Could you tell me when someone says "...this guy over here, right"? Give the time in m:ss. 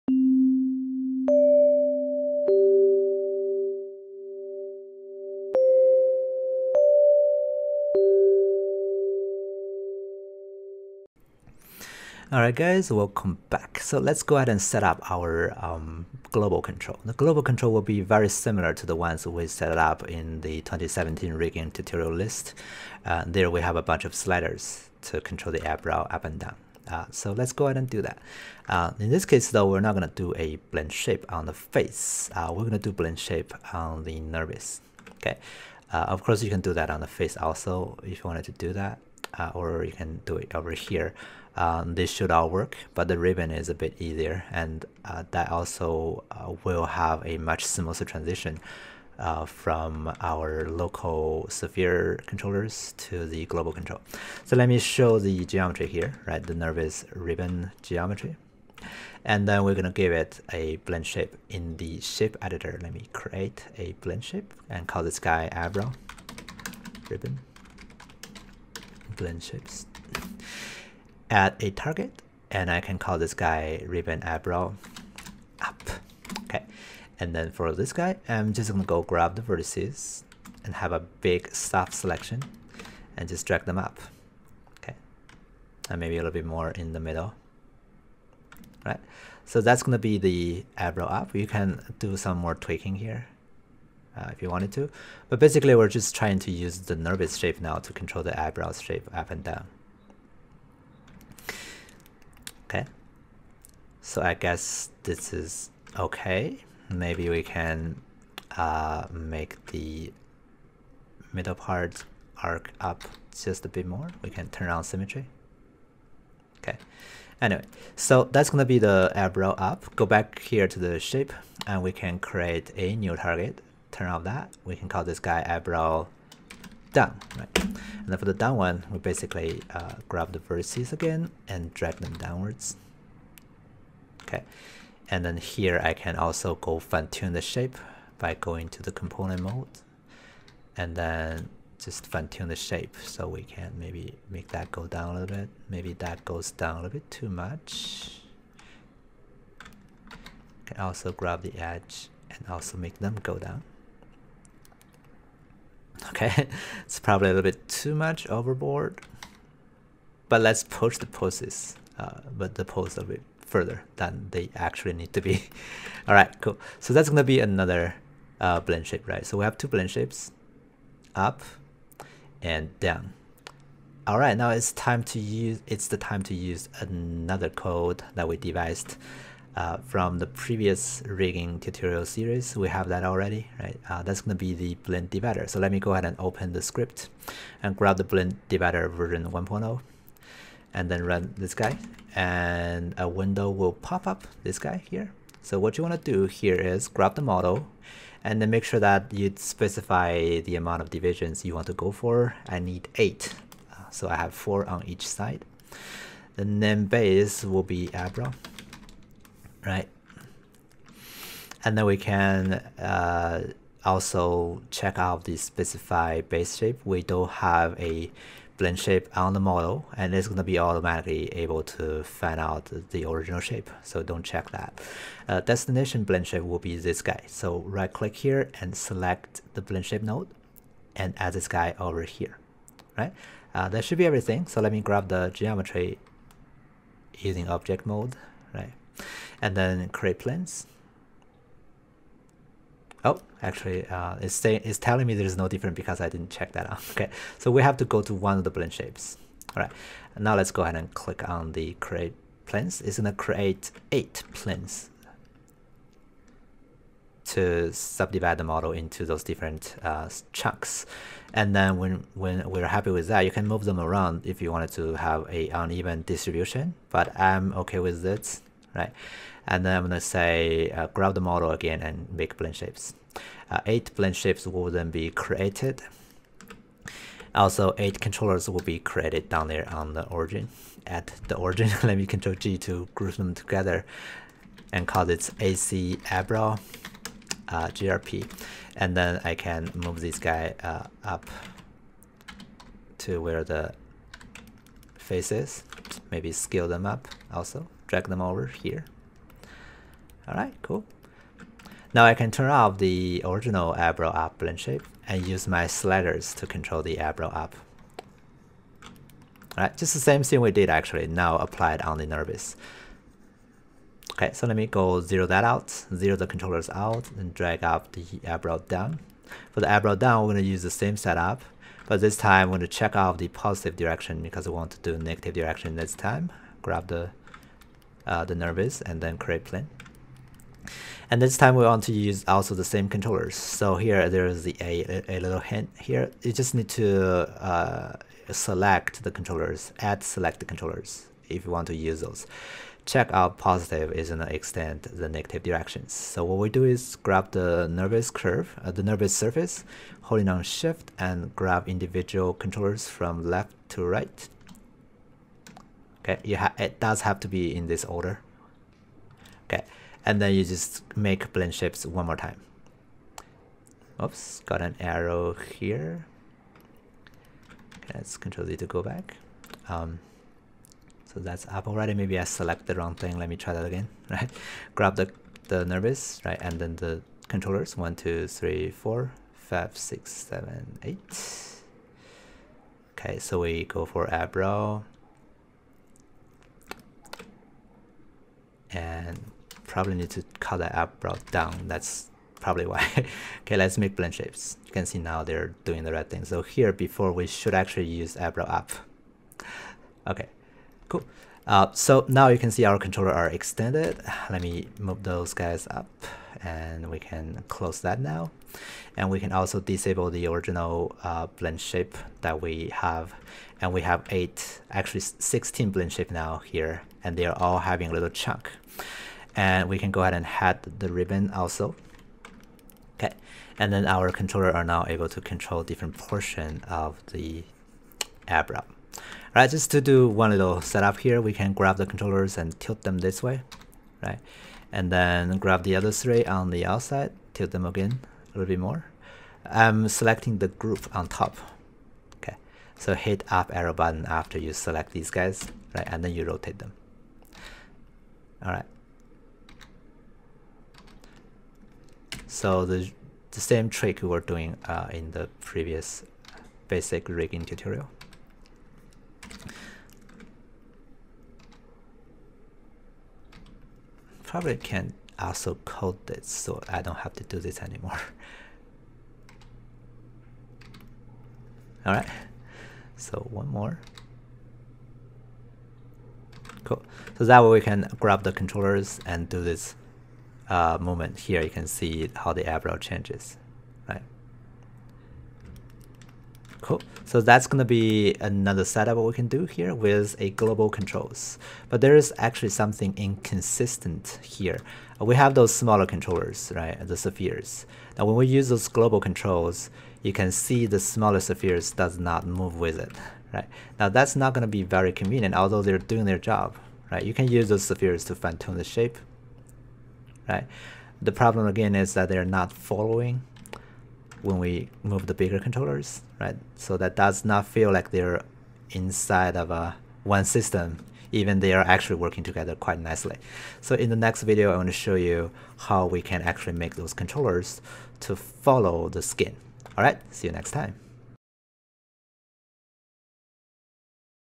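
3:51.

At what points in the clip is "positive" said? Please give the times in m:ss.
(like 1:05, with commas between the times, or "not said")
5:23, 5:43.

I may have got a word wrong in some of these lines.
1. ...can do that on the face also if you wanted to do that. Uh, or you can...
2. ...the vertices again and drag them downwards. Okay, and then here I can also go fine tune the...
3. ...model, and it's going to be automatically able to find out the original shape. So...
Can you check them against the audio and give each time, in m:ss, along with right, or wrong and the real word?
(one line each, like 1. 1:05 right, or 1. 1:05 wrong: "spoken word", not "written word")
1. 0:36 right
2. 2:10 right
3. 3:39 right.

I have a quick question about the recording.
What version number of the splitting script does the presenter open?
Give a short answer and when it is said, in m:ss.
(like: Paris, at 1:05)
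1.0, at 3:09.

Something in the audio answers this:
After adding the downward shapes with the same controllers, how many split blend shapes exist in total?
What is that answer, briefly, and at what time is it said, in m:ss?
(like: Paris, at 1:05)
16, at 6:55.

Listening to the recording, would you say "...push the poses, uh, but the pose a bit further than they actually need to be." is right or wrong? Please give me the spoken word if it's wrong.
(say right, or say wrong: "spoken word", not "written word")
right.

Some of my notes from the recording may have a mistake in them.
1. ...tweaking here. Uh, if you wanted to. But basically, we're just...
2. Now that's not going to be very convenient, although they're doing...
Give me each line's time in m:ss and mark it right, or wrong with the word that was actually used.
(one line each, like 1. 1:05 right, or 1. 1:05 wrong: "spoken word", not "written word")
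1. 1:32 right
2. 8:23 right.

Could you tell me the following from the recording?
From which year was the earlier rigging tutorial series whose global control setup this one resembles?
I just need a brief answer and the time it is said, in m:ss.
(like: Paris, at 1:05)
2017, at 0:20.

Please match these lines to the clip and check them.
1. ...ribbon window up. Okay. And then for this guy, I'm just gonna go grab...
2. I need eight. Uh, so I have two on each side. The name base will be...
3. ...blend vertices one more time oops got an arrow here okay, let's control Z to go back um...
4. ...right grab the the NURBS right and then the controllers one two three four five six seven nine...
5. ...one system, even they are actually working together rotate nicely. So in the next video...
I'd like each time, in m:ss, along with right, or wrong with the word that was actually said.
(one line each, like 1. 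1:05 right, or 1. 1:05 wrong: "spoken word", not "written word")
1. 1:13 wrong: "eyebrow", not "window"
2. 3:22 wrong: "four", not "two"
3. 6:01 wrong: "shapes", not "vertices"
4. 6:14 wrong: "eight", not "nine"
5. 8:40 wrong: "quite", not "rotate".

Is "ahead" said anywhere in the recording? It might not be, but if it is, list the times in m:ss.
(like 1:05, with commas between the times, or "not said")
0:14, 0:27, 3:05, 4:10, 7:00.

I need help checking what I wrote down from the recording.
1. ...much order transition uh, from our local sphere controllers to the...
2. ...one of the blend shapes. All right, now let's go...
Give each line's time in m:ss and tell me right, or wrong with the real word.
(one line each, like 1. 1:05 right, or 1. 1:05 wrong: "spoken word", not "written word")
1. 0:47 wrong: "smoother", not "order"
2. 4:08 right.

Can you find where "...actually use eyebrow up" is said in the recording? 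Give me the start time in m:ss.
6:37.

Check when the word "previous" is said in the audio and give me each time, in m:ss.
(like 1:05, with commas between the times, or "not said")
3:00, 7:35.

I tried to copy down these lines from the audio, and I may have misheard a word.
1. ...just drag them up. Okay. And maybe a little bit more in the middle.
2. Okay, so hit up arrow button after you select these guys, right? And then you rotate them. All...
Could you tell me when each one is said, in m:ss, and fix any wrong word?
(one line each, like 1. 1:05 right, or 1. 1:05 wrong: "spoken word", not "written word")
1. 1:23 right
2. 7:22 right.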